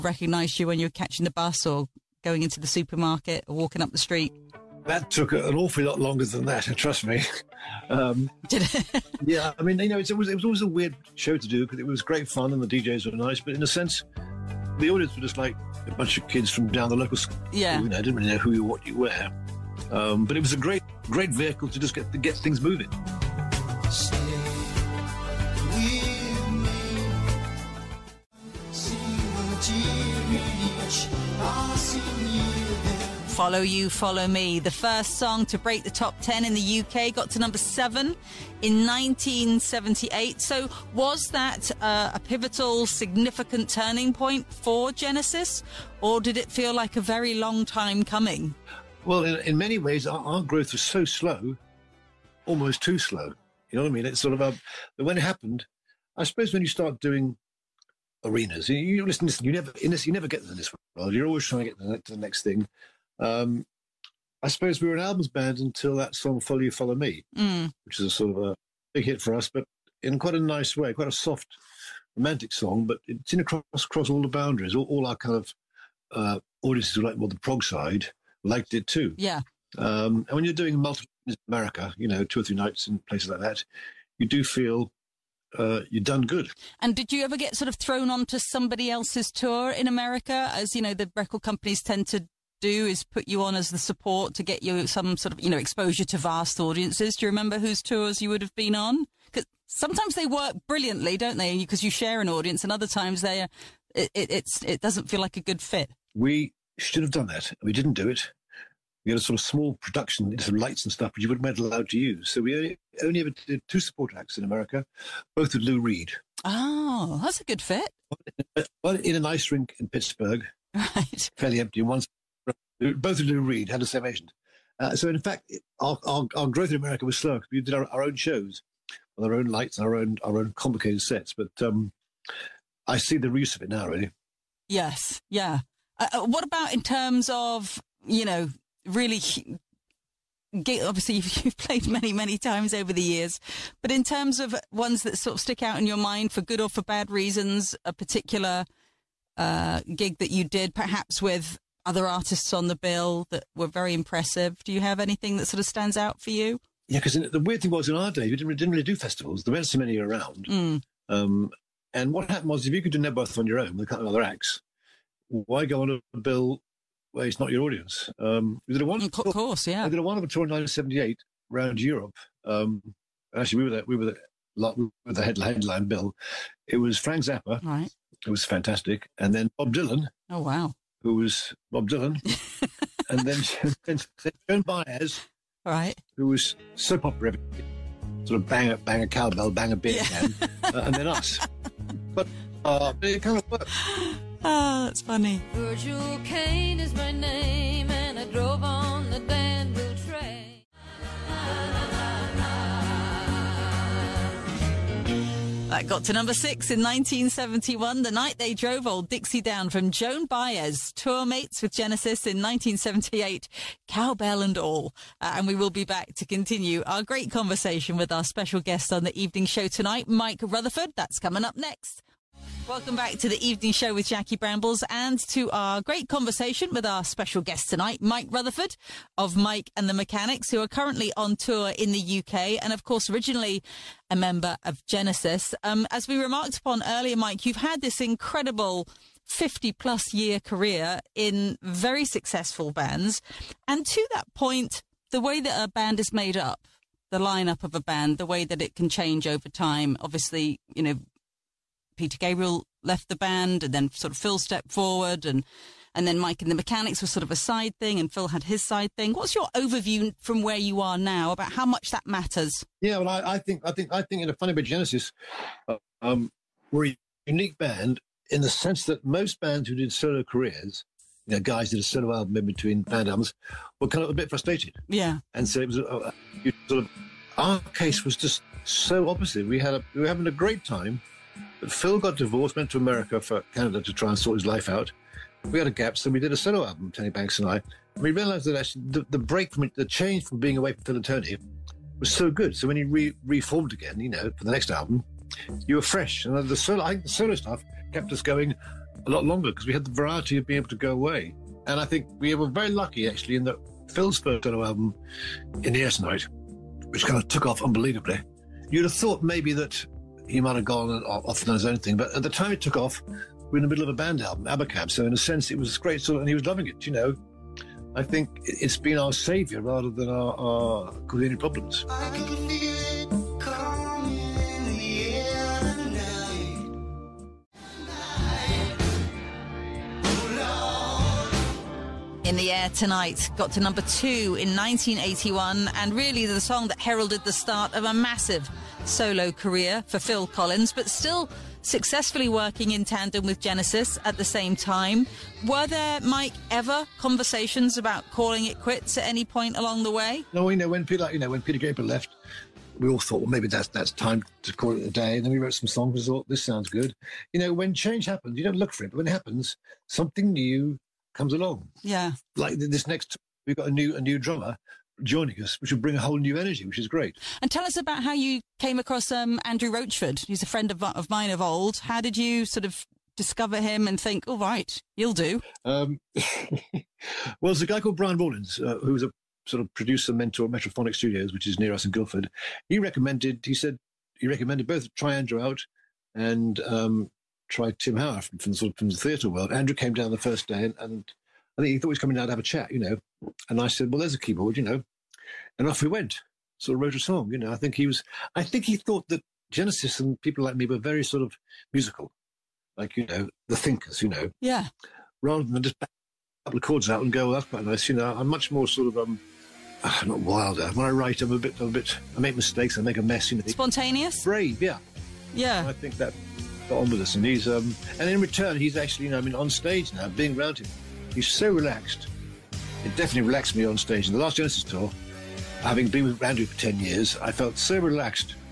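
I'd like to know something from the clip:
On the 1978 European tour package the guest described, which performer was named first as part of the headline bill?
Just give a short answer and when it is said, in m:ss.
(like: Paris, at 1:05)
Frank Zappa, at 2:56.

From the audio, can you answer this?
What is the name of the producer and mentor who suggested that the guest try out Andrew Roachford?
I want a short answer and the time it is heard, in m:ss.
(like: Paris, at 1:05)
Brian Rawlins, at 6:17.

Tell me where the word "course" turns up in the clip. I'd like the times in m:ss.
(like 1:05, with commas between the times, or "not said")
2:49, 3:52.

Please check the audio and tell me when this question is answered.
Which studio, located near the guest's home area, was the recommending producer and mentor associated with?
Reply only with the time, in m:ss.
6:20.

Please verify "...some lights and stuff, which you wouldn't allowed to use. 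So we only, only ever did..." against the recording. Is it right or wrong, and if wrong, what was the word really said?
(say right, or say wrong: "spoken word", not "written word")
right.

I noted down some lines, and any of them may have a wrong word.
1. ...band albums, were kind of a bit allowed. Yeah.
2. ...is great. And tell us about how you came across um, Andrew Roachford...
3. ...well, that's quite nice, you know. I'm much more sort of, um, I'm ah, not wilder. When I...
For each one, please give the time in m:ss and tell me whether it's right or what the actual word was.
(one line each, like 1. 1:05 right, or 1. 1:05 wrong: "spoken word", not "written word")
1. 4:32 wrong: "frustrated", not "allowed"
2. 6:06 right
3. 6:47 right.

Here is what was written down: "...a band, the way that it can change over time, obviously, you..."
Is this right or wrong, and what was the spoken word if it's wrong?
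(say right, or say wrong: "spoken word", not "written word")
right.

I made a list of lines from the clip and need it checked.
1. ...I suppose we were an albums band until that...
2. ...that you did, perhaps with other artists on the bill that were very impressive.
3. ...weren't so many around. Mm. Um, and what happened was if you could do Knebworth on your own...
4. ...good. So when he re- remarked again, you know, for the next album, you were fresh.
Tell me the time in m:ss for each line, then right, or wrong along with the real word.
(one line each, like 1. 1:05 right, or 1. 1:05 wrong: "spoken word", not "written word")
1. 1:04 right
2. 2:30 right
3. 2:39 right
4. 4:52 wrong: "reformed", not "remarked".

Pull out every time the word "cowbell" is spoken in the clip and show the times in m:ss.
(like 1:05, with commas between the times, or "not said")
3:09, 3:33.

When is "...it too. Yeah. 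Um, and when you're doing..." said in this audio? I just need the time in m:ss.
1:18.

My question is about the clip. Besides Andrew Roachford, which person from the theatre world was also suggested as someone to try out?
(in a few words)
Tim Howard.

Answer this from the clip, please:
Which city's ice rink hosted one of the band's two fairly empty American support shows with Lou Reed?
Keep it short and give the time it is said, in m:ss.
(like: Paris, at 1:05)
Pittsburgh, at 1:59.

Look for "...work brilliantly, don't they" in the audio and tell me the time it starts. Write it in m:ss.
1:40.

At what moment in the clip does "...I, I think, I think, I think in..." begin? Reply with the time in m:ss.
4:23.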